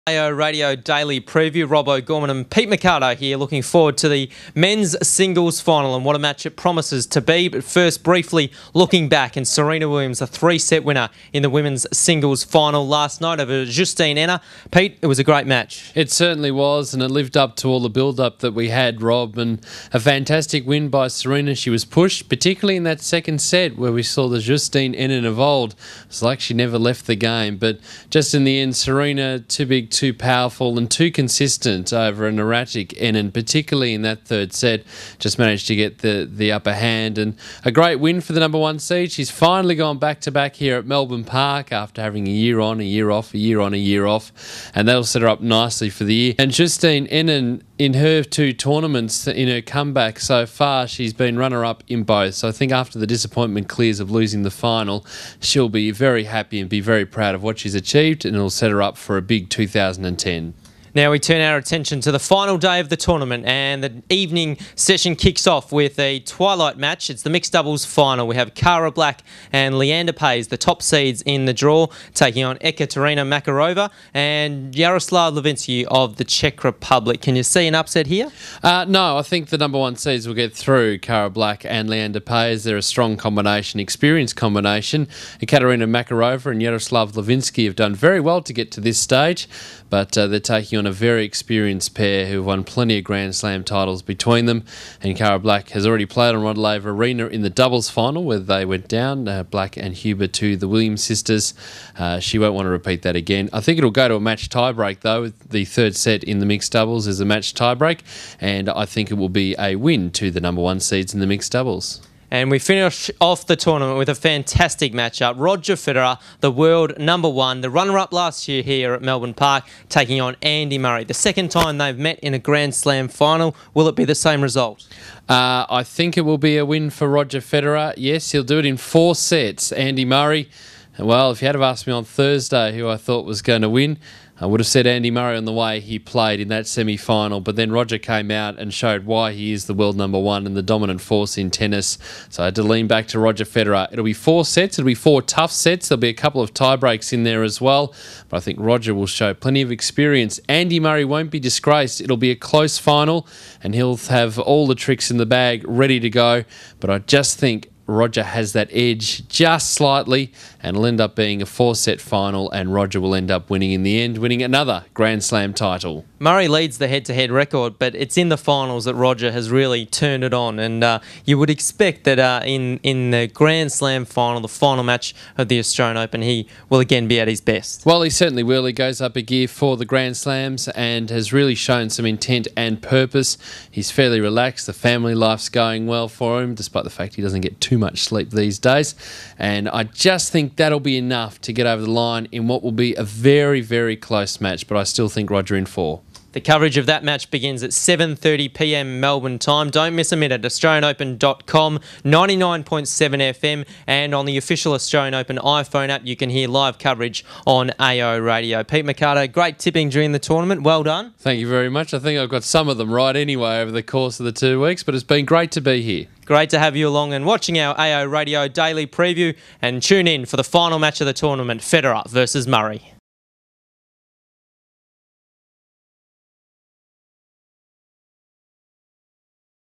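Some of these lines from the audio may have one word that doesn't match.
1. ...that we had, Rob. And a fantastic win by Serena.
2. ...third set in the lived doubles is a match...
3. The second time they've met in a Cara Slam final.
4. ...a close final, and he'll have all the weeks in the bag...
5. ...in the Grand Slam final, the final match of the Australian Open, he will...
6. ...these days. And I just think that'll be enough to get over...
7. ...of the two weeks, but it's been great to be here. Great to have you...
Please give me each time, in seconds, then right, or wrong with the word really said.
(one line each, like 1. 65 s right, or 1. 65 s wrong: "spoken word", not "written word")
1. 18 s right
2. 105 s wrong: "mixed", not "lived"
3. 121 s wrong: "Grand", not "Cara"
4. 152 s wrong: "tricks", not "weeks"
5. 172 s right
6. 188 s right
7. 214 s right.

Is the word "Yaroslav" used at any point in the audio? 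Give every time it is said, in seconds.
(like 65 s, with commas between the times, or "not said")
74 s, 86 s.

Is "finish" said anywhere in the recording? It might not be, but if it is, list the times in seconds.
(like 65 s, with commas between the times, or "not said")
112 s.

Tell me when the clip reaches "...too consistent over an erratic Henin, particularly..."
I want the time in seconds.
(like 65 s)
30 s.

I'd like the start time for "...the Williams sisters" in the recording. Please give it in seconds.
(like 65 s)
100 s.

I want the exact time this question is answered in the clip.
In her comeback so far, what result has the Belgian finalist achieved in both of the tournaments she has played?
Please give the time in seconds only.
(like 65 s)
51 s.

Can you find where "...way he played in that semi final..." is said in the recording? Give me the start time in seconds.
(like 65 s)
135 s.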